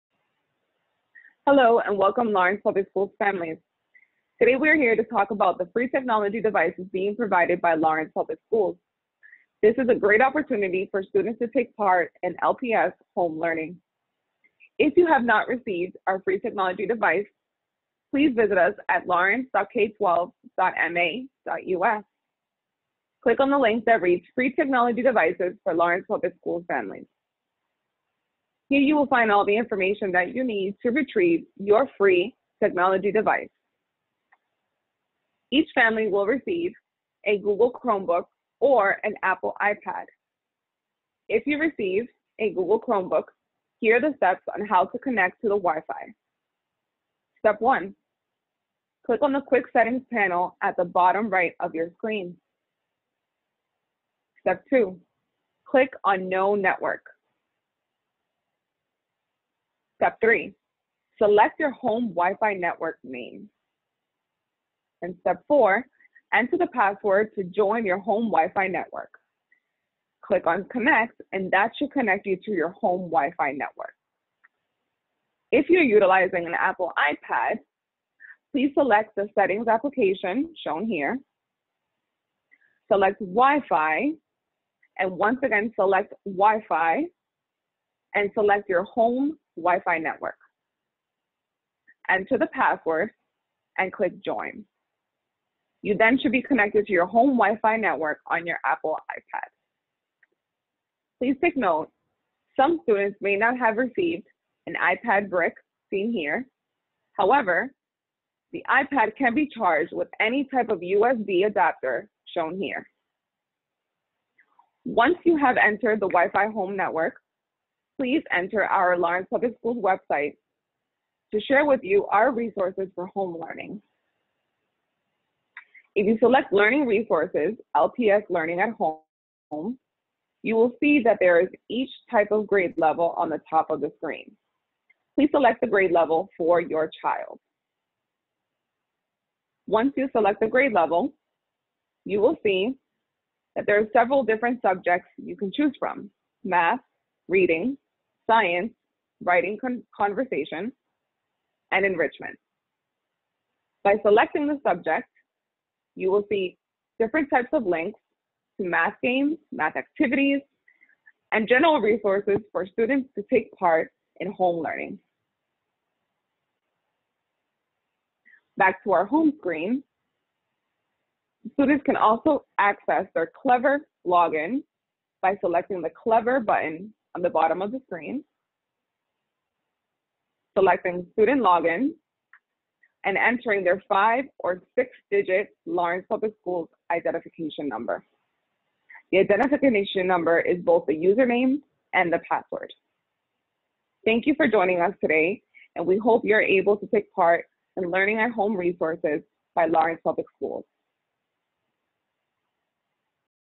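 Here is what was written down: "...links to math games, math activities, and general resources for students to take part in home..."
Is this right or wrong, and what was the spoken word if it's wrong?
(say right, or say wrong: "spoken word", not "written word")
right.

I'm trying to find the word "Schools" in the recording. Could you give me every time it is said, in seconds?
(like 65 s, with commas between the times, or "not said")
2 s, 8 s, 26 s, 119 s, 186 s, 200 s.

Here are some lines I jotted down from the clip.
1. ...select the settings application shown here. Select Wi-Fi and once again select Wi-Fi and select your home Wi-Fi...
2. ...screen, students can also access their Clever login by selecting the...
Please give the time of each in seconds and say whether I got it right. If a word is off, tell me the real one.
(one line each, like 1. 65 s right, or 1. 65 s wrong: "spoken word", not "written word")
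1. 78 s right
2. 169 s right.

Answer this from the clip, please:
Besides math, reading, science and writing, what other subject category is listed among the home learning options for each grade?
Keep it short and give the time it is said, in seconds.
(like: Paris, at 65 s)
Enrichment, at 151 s.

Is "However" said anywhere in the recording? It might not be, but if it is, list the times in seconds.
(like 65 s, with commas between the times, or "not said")
107 s.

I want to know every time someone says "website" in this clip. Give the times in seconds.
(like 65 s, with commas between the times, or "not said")
119 s.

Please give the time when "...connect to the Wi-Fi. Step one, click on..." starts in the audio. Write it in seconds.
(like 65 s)
44 s.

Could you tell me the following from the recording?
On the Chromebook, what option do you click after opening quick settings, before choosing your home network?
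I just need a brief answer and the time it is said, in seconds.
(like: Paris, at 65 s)
No network, at 56 s.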